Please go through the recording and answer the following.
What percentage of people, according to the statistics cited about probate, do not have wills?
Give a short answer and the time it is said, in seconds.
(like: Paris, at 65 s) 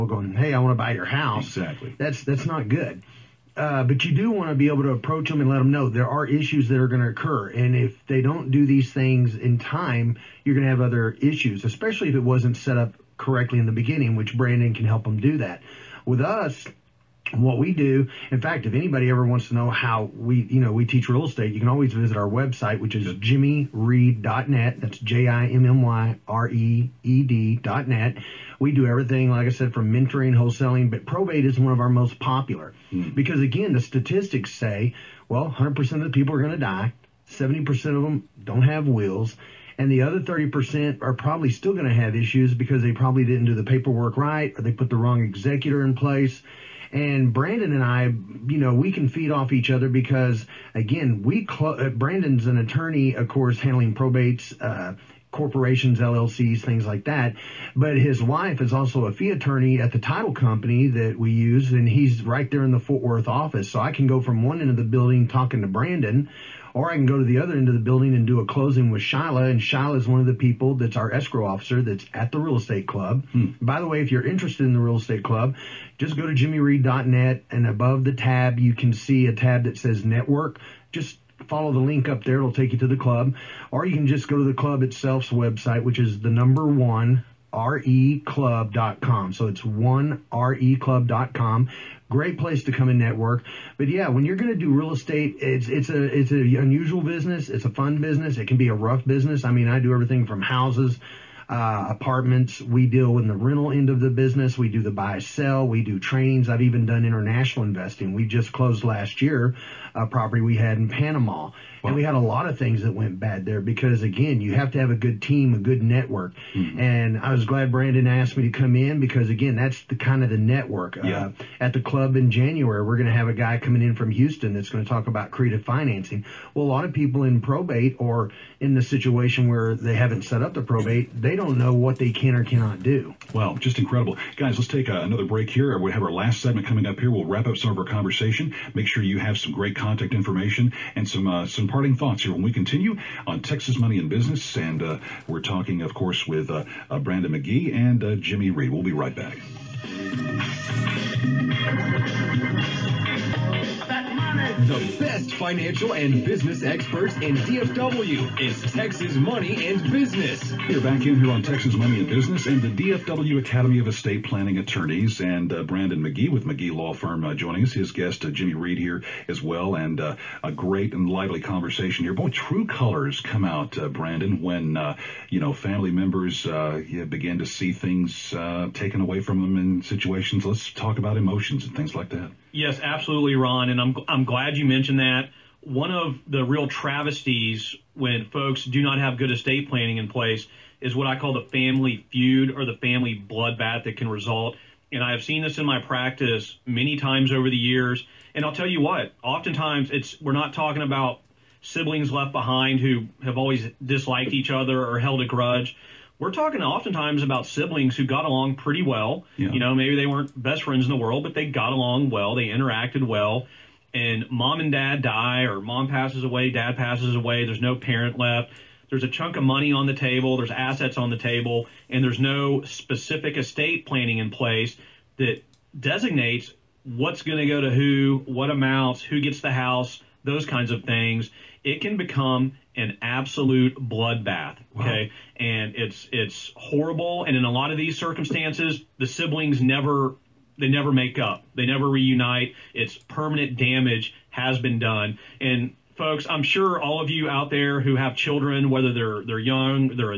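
70%, at 37 s.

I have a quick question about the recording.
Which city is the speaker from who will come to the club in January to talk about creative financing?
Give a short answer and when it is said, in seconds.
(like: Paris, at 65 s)
Houston, at 124 s.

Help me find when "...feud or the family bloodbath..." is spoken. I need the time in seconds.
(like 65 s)
192 s.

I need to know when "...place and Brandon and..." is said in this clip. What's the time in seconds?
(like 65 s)
45 s.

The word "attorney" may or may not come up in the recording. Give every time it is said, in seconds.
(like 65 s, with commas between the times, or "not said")
52 s, 59 s, 164 s.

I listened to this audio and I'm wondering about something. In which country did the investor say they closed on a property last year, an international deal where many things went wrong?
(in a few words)
Panama.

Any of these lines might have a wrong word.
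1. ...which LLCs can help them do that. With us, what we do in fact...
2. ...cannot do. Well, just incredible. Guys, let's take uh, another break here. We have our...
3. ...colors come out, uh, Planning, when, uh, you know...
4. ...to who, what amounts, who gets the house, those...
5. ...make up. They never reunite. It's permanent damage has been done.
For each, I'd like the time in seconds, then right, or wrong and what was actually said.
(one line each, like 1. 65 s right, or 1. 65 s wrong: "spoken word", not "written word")
1. 14 s wrong: "Brandon", not "LLCs"
2. 132 s right
3. 172 s wrong: "Brandon", not "Planning"
4. 227 s right
5. 240 s right.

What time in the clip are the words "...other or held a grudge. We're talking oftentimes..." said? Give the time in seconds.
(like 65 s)
204 s.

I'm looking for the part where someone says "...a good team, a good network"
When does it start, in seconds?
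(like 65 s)
114 s.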